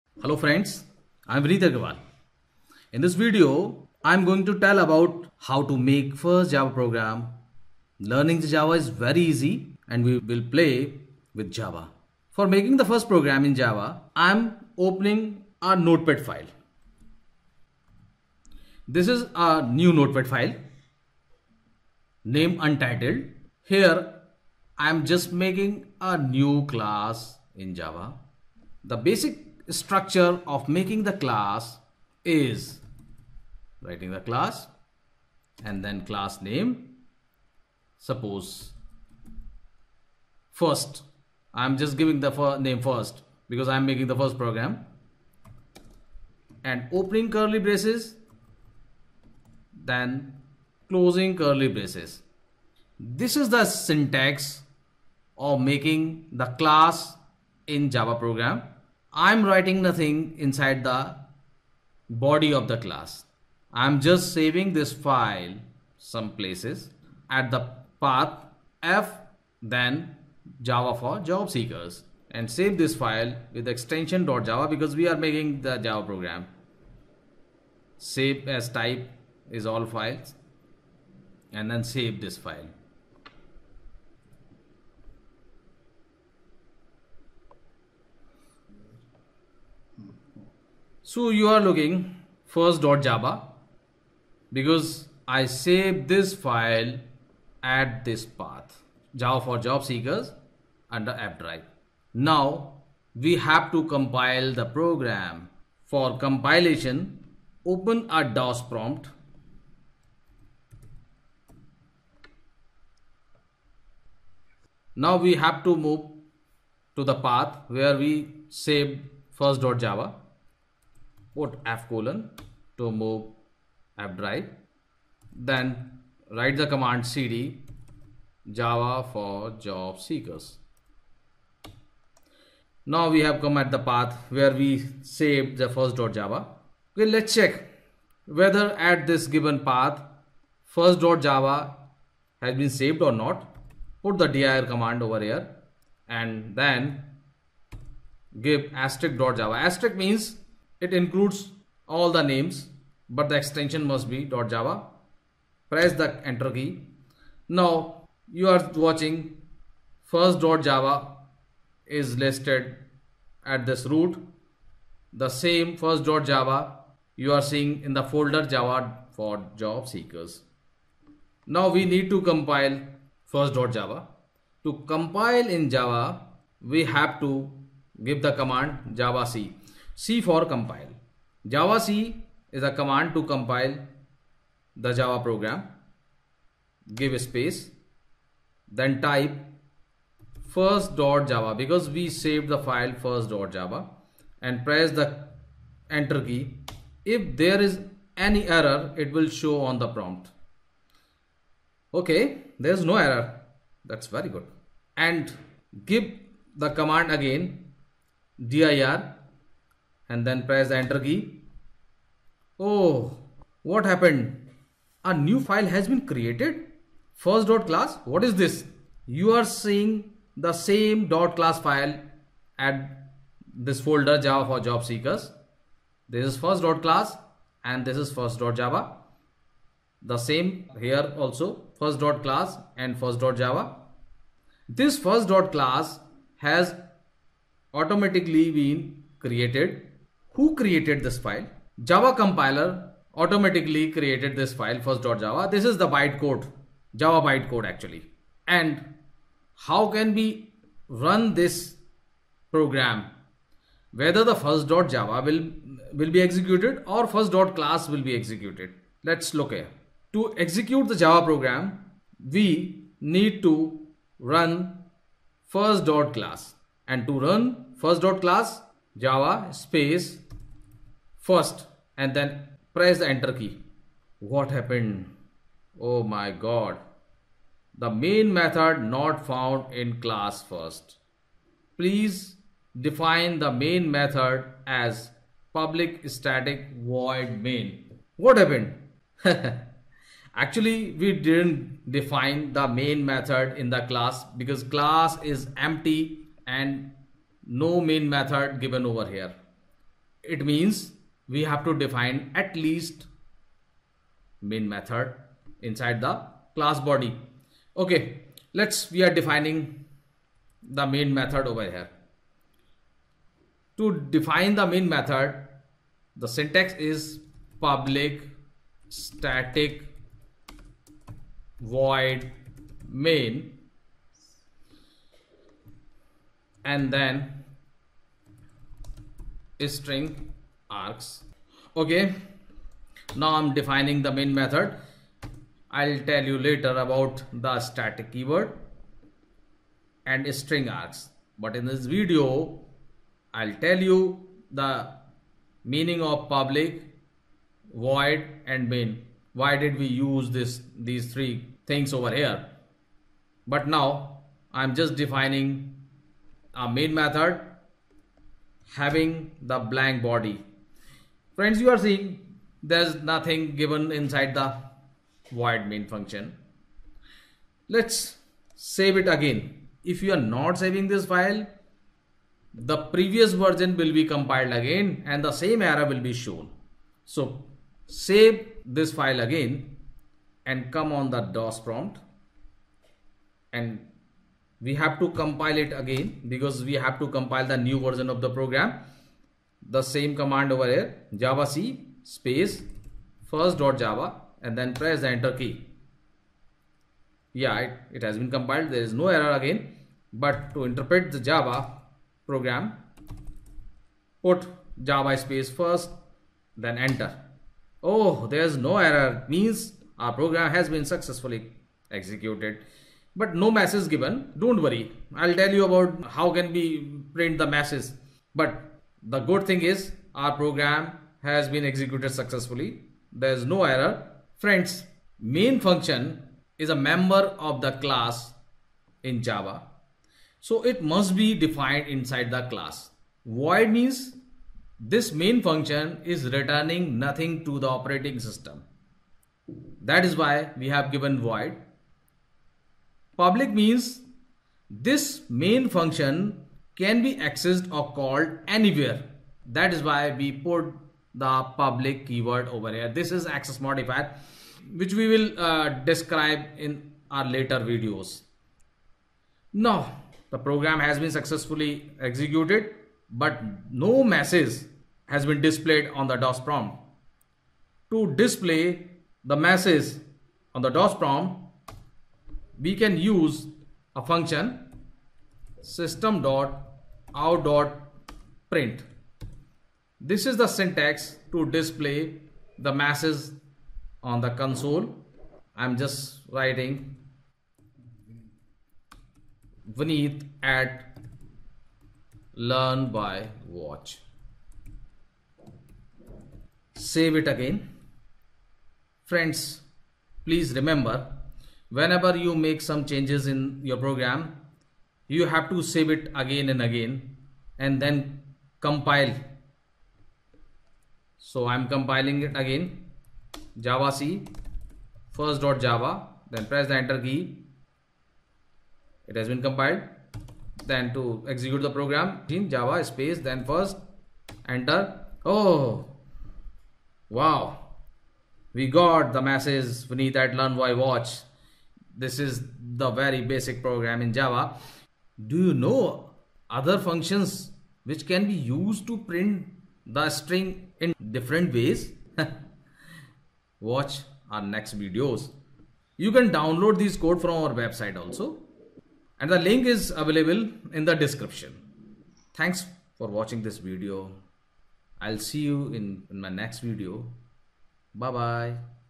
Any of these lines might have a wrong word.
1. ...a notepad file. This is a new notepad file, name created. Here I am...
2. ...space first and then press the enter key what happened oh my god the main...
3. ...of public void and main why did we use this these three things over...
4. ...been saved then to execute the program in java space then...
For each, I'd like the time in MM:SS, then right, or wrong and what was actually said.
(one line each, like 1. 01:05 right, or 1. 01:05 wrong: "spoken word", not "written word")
1. 00:15 wrong: "untitled", not "created"
2. 04:29 right
3. 05:46 right
4. 08:39 wrong: "compiled", not "saved".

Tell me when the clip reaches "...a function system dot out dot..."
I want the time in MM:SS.
07:53.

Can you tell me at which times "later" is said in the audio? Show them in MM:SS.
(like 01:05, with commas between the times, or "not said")
05:36, 07:37.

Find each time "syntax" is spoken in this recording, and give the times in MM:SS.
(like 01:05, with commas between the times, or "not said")
00:53, 05:16, 08:00.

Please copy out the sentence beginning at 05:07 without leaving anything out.
Okay, let's we are defining the main method over here.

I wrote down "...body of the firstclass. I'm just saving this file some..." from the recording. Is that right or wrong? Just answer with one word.
wrong.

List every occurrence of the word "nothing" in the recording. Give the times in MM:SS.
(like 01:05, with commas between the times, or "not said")
00:59, 06:03, 07:16.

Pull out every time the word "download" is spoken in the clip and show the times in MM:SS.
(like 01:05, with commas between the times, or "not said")
09:06.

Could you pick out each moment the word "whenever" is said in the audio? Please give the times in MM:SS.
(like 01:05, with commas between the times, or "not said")
08:21.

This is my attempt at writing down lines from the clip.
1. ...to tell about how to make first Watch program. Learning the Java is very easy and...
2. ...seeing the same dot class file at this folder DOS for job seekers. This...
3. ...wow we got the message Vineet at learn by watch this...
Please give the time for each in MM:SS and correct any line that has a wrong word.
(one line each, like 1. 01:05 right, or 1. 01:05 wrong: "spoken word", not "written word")
1. 00:04 wrong: "Java", not "Watch"
2. 03:39 wrong: "Java", not "DOS"
3. 08:47 right.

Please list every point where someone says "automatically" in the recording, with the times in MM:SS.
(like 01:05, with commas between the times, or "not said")
03:57, 04:03.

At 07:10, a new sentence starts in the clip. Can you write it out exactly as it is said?
So it must be defined inside the class.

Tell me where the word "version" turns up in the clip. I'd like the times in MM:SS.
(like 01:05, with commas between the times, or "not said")
06:13, 06:27.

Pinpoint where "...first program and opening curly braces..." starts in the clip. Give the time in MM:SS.
00:44.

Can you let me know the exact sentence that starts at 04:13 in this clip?
Whether the first.java will, will be executed or first.class will be executed.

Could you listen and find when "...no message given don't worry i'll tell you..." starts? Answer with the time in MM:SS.
06:53.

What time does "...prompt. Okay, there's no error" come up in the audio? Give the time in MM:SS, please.
03:19.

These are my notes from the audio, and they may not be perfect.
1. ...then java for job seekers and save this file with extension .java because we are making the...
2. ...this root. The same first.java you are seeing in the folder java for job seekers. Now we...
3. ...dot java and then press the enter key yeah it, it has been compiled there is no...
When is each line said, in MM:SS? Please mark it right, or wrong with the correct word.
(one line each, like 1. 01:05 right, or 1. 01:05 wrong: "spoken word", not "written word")
1. 01:09 right
2. 02:43 right
3. 06:33 right.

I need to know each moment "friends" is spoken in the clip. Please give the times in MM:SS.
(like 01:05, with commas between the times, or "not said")
00:00, 06:01, 07:04, 08:19.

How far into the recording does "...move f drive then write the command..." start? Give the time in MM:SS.
02:02.